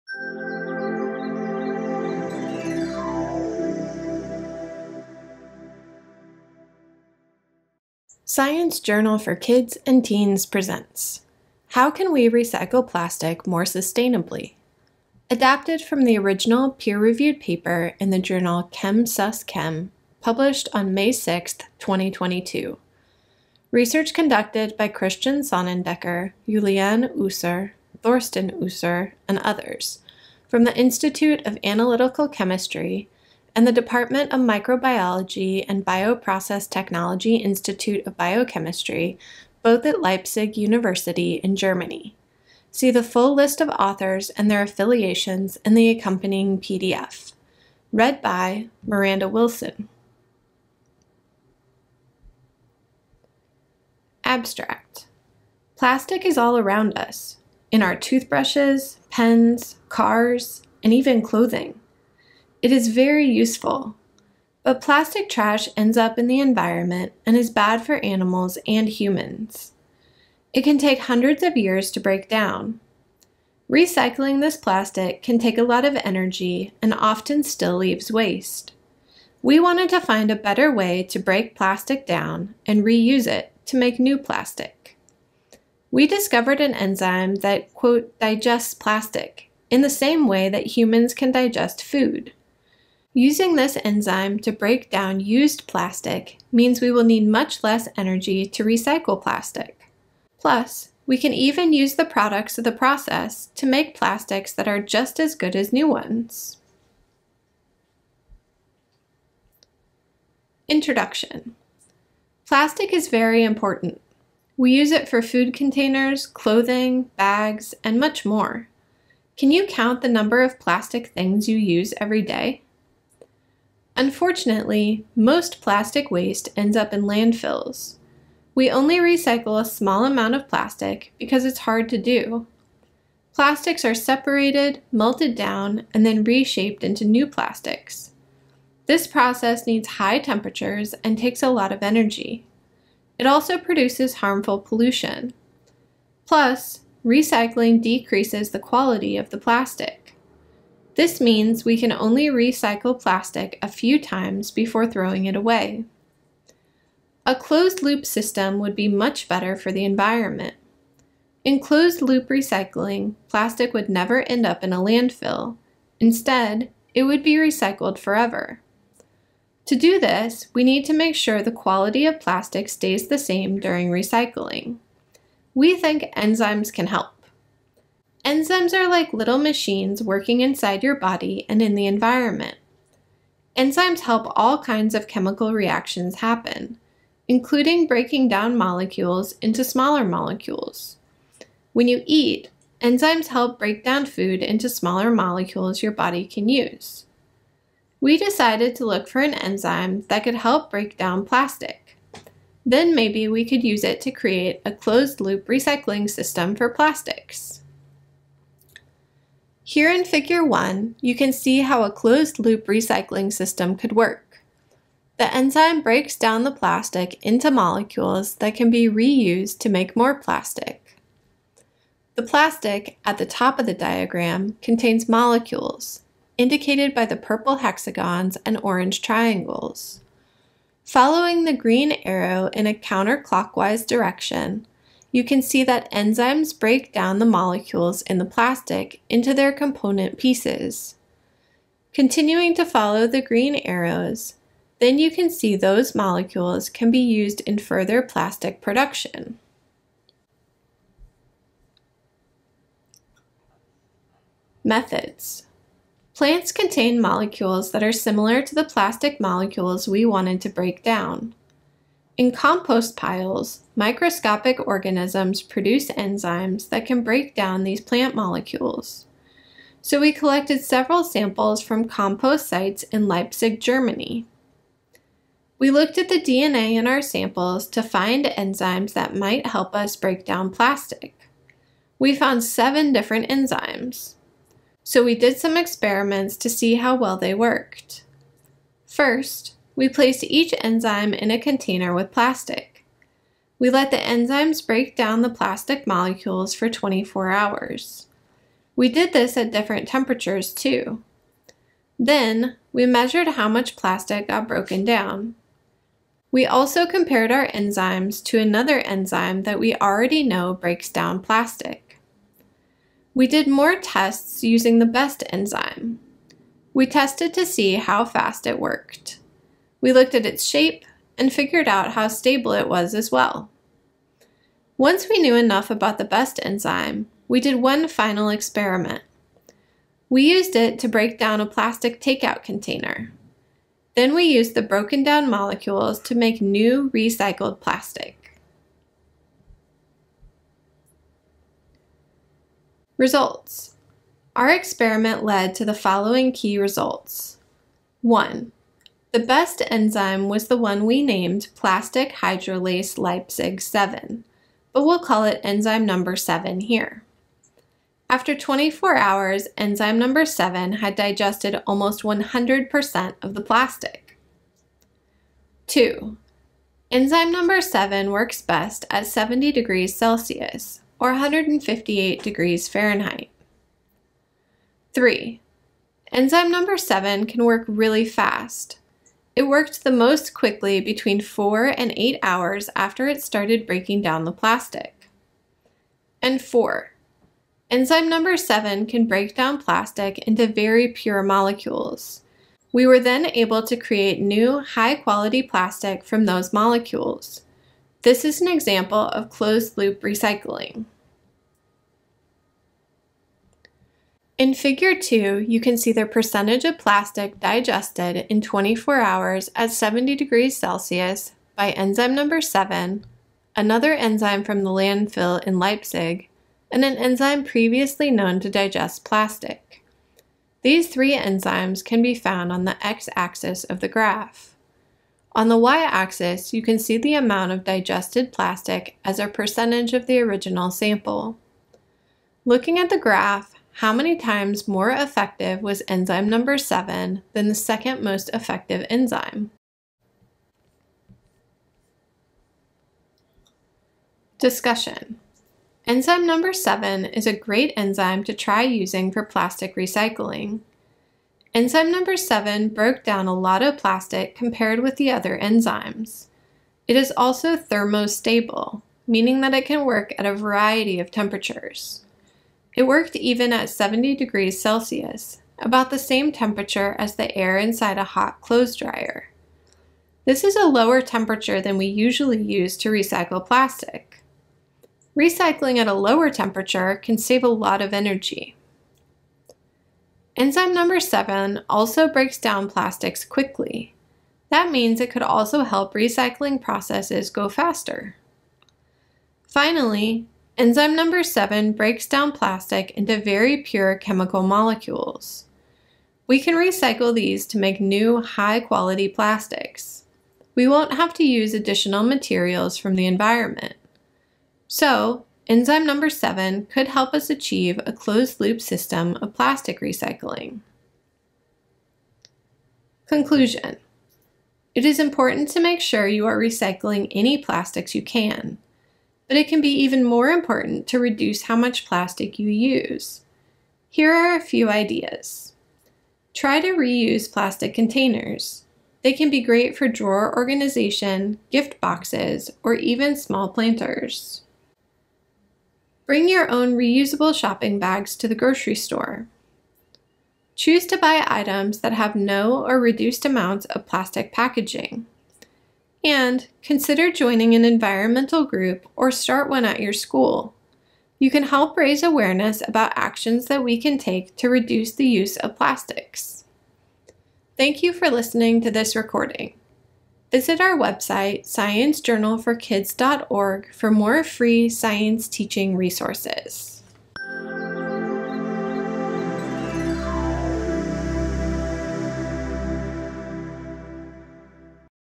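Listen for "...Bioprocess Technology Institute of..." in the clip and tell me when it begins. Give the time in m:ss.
0:35.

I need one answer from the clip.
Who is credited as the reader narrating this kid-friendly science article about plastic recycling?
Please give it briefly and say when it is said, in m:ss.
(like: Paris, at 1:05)
Miranda Wilson, at 0:48.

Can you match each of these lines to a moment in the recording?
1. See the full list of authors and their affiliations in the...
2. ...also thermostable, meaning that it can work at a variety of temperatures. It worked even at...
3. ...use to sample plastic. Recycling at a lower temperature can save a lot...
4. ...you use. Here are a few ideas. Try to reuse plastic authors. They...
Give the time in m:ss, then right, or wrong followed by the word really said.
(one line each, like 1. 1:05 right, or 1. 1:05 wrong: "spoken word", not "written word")
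1. 0:42 right
2. 7:37 right
3. 7:52 wrong: "recycle", not "sample"
4. 8:42 wrong: "containers", not "authors".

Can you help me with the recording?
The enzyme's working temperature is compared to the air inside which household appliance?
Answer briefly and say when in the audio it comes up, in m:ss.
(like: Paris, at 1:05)
hot clothes dryer, at 7:48.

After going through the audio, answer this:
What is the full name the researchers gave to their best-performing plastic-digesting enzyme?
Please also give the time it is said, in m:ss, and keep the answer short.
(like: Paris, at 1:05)
plastic hydrolase Leipzig 7, at 5:51.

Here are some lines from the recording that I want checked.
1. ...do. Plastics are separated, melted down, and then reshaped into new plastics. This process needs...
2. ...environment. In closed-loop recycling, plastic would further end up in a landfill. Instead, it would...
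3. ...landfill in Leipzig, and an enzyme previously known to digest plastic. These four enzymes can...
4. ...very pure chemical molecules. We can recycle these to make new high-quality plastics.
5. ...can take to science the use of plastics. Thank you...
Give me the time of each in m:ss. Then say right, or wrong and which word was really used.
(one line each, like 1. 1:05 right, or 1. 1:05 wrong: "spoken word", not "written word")
1. 2:11 right
2. 2:39 wrong: "never", not "further"
3. 6:54 wrong: "three", not "four"
4. 8:13 right
5. 9:13 wrong: "reduce", not "science".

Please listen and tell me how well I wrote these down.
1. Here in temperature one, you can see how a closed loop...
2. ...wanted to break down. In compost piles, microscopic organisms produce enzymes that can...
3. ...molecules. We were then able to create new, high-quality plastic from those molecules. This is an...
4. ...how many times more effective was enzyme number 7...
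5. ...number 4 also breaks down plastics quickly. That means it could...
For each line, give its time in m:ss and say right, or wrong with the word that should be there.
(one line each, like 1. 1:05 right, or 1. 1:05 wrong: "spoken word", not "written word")
1. 3:29 wrong: "figure", not "temperature"
2. 4:20 right
3. 6:31 right
4. 7:13 right
5. 8:00 wrong: "7", not "4".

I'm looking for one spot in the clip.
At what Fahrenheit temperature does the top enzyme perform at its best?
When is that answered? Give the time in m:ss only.
6:11.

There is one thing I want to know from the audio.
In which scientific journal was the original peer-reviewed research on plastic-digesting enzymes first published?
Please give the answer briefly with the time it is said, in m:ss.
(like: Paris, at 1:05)
ChemSusChem, at 0:18.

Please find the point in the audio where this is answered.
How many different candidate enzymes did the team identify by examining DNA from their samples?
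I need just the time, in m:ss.
4:42.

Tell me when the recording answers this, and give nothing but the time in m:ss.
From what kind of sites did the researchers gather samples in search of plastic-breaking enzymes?
4:31.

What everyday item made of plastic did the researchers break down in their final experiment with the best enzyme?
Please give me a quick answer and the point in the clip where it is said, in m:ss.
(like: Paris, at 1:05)
takeout container, at 5:31.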